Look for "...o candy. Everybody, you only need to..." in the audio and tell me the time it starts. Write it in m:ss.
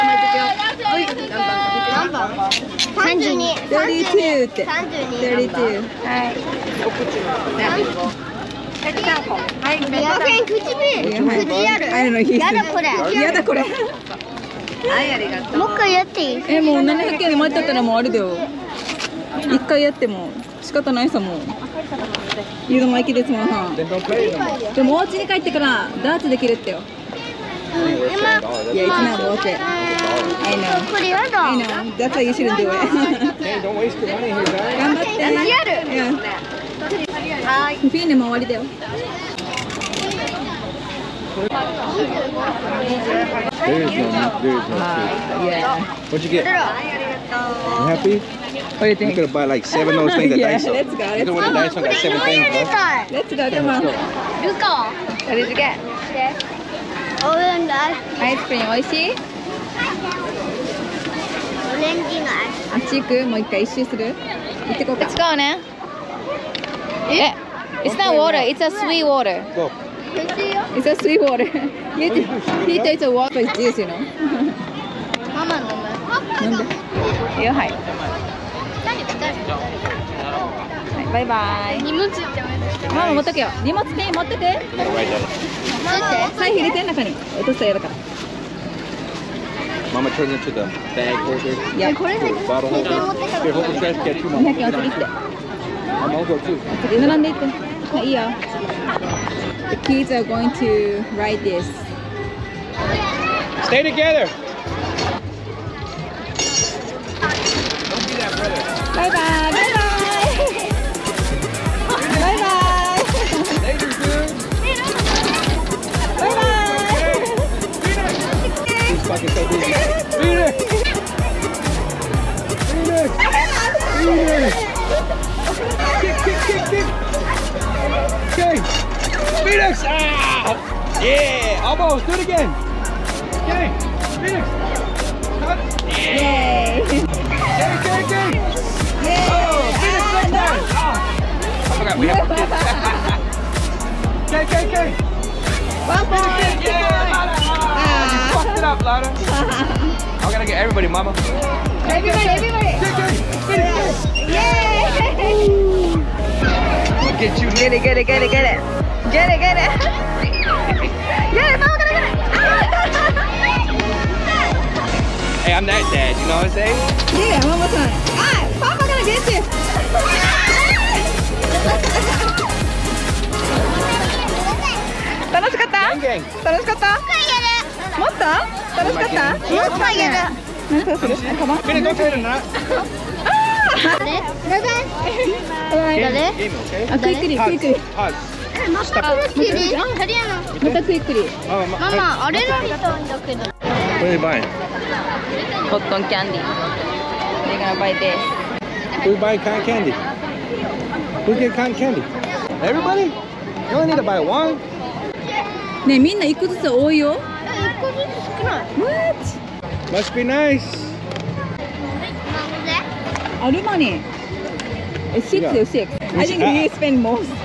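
3:19.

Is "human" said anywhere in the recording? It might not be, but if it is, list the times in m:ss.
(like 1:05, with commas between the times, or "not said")
not said.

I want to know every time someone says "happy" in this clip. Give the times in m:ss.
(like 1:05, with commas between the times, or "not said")
0:46.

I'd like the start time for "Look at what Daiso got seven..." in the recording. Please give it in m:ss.
0:50.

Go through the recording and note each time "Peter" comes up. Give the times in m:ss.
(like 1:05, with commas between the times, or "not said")
1:12.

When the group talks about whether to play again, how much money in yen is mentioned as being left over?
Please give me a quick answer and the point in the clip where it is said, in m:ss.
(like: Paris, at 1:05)
700 yen, at 0:16.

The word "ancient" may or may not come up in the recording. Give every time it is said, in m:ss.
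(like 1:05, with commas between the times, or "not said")
not said.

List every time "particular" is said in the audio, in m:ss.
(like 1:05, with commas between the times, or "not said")
not said.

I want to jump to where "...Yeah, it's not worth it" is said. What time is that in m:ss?
0:27.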